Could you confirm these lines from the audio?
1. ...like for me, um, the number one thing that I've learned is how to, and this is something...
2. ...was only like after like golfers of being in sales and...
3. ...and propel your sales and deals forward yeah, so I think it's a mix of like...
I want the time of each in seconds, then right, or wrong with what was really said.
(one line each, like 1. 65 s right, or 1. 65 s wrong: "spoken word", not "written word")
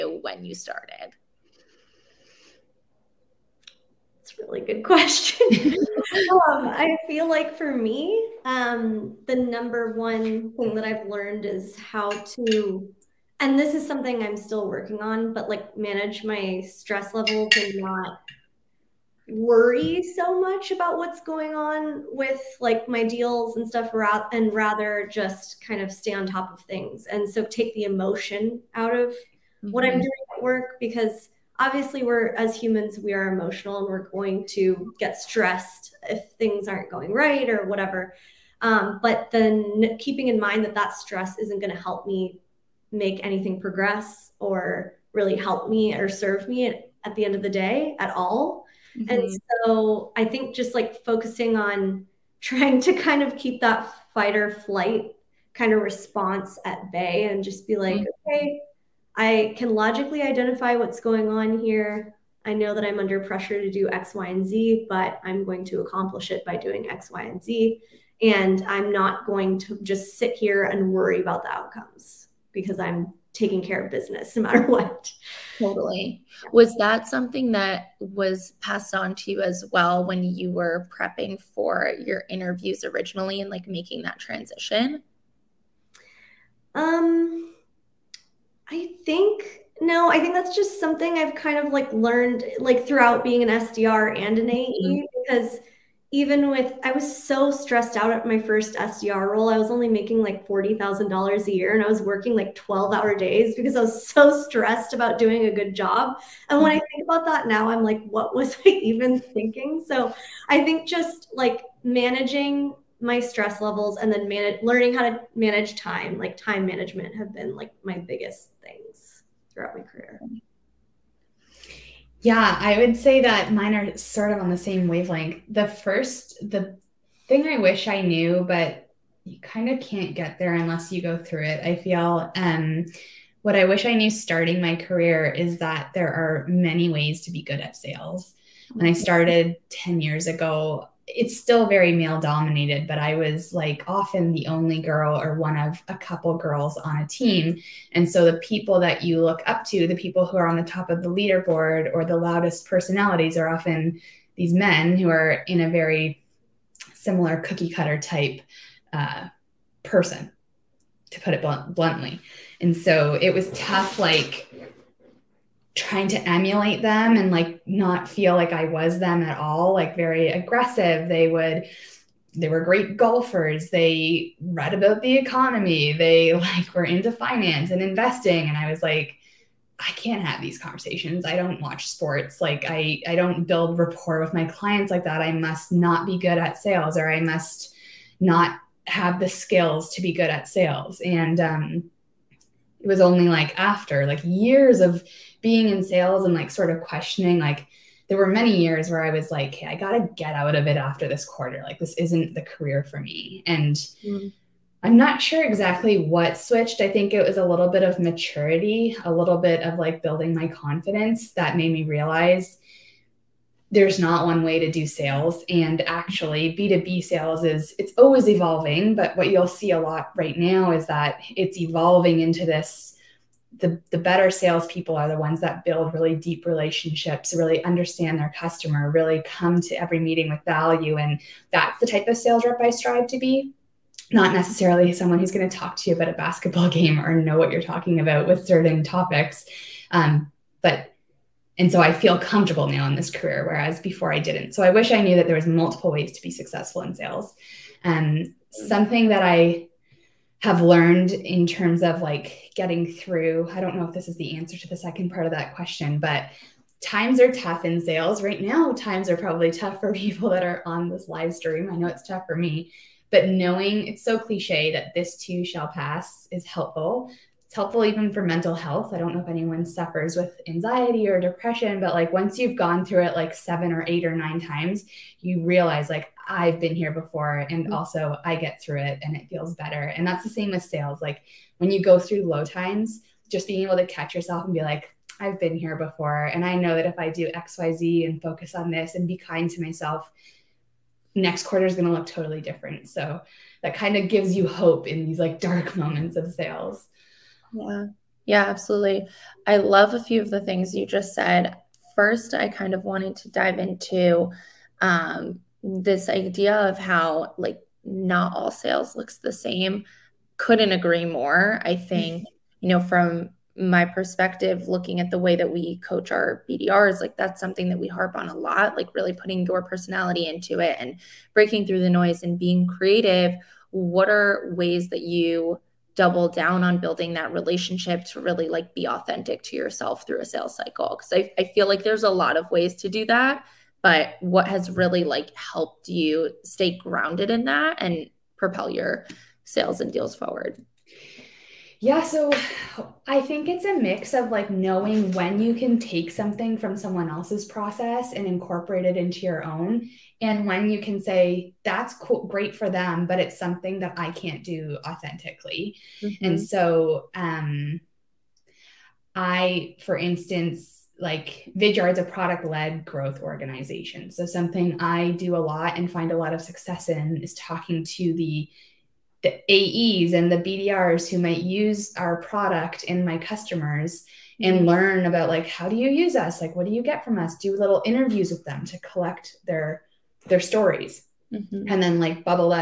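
1. 7 s right
2. 192 s wrong: "years", not "golfers"
3. 337 s right.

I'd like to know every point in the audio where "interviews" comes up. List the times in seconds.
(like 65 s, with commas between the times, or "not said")
82 s, 377 s.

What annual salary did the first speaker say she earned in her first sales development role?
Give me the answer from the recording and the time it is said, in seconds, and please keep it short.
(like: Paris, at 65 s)
$40,000, at 100 s.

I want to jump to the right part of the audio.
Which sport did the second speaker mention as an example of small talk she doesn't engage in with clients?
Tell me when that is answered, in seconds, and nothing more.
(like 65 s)
236 s.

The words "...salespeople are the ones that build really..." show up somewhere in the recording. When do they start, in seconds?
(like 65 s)
224 s.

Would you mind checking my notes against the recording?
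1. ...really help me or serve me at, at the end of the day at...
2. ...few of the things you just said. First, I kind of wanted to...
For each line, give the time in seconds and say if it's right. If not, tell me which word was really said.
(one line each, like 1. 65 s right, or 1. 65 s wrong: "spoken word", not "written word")
1. 45 s right
2. 300 s right.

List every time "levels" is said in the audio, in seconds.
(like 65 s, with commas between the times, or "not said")
17 s, 113 s.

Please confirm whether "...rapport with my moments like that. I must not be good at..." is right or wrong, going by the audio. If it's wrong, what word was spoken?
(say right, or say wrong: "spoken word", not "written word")
wrong: "clients", not "moments".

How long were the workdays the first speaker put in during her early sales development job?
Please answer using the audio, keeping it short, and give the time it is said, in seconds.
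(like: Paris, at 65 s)
12-hour days, at 102 s.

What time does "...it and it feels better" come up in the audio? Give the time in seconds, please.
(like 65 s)
278 s.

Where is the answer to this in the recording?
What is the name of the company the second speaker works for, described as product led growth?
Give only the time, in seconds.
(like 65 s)
361 s.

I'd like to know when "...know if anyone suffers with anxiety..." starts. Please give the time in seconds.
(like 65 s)
269 s.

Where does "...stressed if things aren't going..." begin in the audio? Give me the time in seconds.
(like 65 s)
35 s.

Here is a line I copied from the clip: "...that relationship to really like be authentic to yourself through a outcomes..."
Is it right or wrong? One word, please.
wrong.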